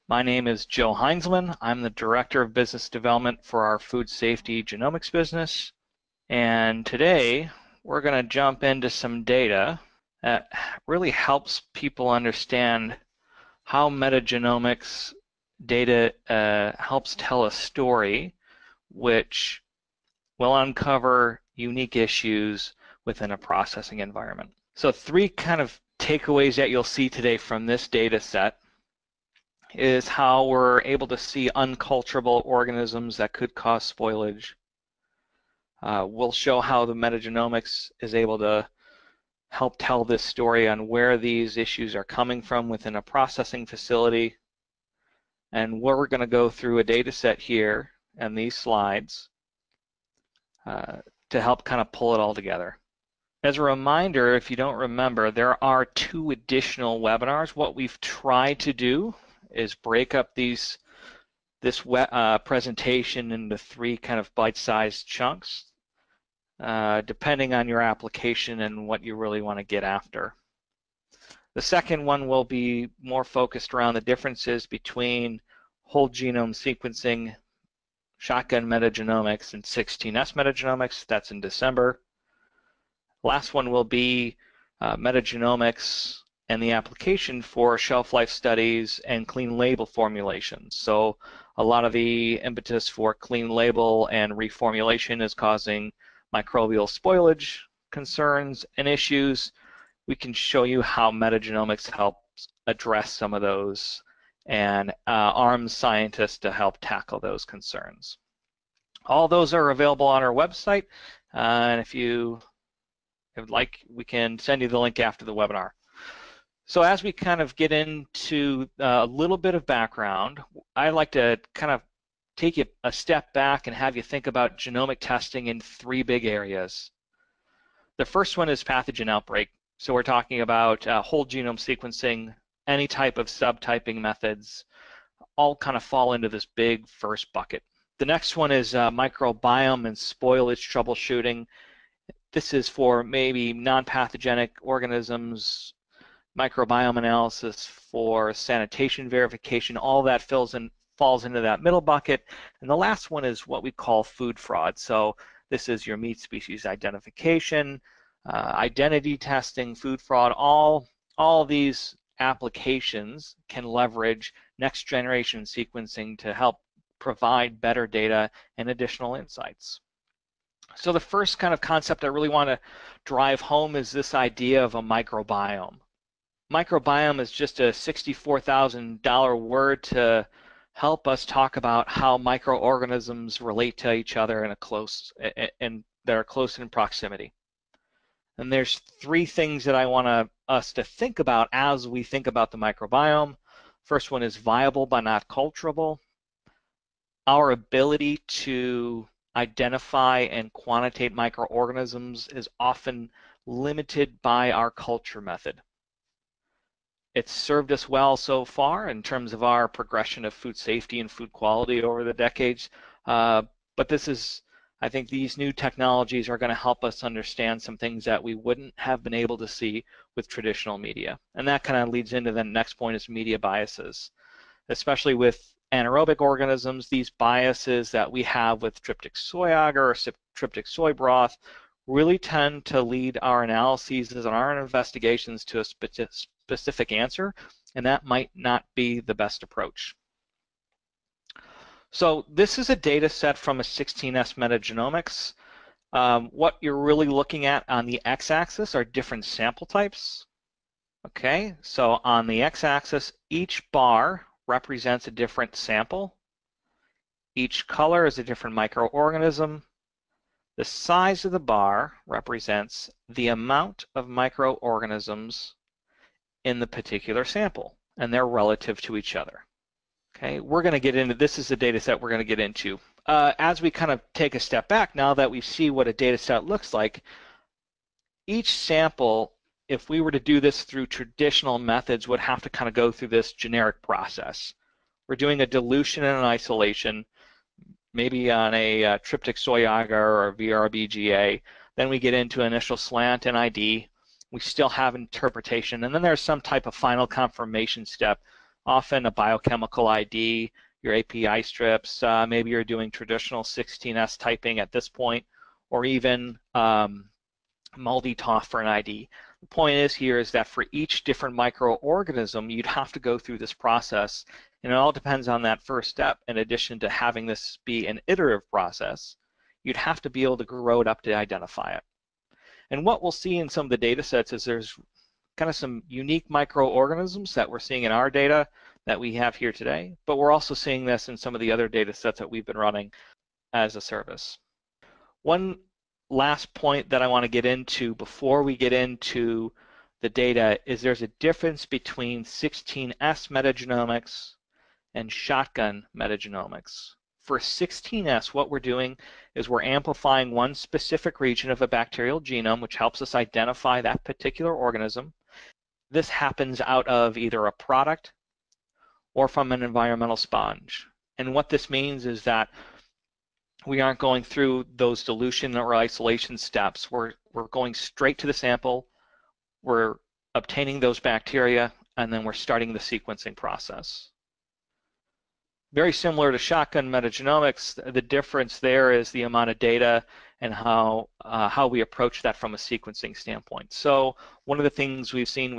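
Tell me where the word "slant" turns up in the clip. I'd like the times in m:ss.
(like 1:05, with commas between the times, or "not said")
4:52.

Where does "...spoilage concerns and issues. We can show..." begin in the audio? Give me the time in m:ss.
1:36.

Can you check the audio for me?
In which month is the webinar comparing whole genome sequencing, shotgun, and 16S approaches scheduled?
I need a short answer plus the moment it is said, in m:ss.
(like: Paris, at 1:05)
December, at 1:21.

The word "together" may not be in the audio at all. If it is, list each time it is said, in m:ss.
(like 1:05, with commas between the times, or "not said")
0:52.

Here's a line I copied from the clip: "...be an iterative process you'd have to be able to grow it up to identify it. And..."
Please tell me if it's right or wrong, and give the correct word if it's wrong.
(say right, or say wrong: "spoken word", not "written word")
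right.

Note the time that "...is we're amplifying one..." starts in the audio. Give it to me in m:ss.
5:49.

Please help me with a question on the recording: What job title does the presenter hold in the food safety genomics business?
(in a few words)
Director of Business Development.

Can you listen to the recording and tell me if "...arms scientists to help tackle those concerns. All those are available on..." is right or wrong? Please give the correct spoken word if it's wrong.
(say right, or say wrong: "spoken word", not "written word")
right.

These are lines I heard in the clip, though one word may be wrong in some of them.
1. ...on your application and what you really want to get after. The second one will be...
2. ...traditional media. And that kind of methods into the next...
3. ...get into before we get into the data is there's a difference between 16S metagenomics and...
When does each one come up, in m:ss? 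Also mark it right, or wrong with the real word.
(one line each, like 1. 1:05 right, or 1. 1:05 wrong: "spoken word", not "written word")
1. 1:07 right
2. 3:40 wrong: "leads", not "methods"
3. 5:37 right.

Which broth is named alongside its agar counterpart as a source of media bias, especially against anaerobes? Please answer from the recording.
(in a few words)
Tryptic soy broth.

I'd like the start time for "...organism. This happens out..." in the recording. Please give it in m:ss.
5:54.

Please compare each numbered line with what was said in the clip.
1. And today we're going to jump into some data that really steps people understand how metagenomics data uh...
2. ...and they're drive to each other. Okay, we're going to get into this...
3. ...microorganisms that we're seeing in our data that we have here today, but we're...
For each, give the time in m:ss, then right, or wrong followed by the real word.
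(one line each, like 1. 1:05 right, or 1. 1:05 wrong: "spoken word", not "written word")
1. 0:06 wrong: "helps", not "steps"
2. 4:27 wrong: "relative", not "drive"
3. 5:26 right.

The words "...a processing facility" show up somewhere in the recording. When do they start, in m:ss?
0:42.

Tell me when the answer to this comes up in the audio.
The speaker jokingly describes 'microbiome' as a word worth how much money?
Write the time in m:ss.
2:57.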